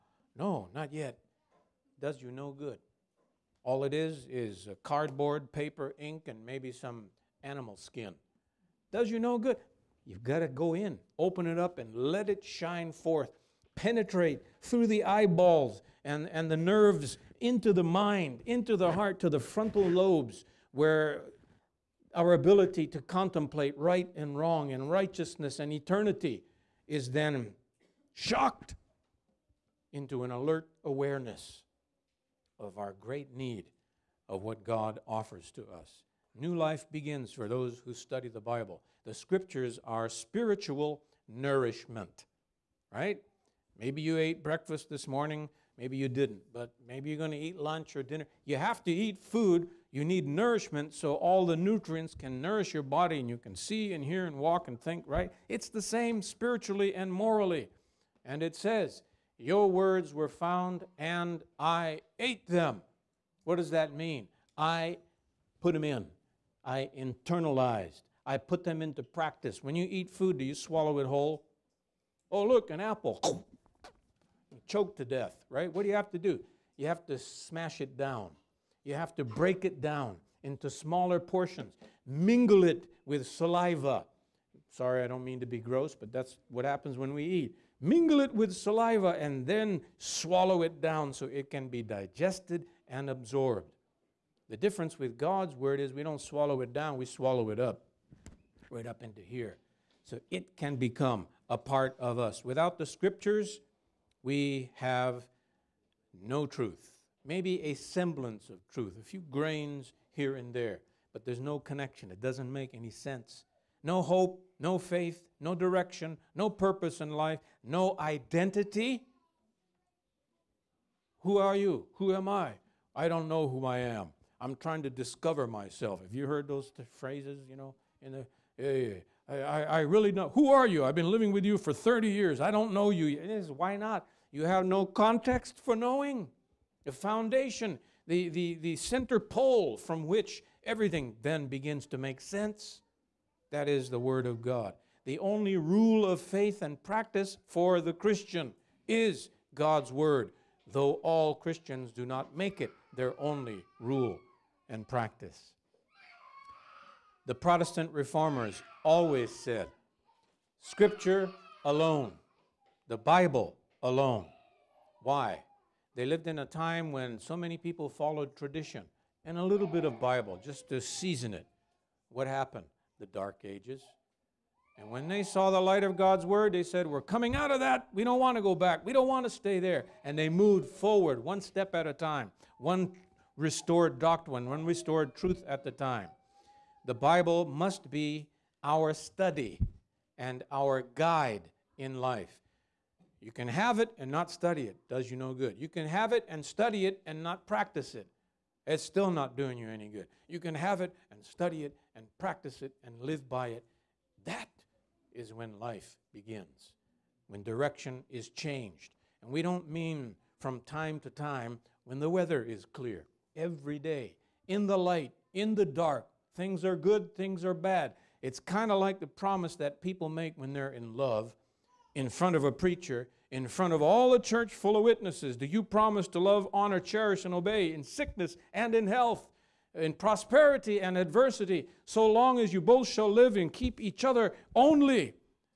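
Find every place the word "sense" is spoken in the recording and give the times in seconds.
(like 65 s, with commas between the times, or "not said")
112 s, 142 s.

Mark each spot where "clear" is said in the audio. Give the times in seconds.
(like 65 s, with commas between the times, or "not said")
212 s.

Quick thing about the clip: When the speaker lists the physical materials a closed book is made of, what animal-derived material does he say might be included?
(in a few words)
animal skin.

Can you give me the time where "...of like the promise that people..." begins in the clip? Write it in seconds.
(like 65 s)
218 s.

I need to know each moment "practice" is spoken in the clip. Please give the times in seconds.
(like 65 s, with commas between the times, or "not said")
69 s, 146 s, 154 s, 197 s, 202 s.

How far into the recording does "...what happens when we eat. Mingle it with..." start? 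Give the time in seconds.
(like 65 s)
86 s.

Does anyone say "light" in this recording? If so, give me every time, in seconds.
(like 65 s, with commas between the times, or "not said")
175 s, 214 s.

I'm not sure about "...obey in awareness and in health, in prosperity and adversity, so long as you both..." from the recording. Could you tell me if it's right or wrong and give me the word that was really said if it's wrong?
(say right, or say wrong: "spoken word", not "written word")
wrong: "sickness", not "awareness".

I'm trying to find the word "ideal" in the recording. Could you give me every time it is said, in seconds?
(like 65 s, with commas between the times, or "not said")
not said.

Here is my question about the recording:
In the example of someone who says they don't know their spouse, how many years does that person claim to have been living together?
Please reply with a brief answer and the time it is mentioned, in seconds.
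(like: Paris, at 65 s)
30, at 131 s.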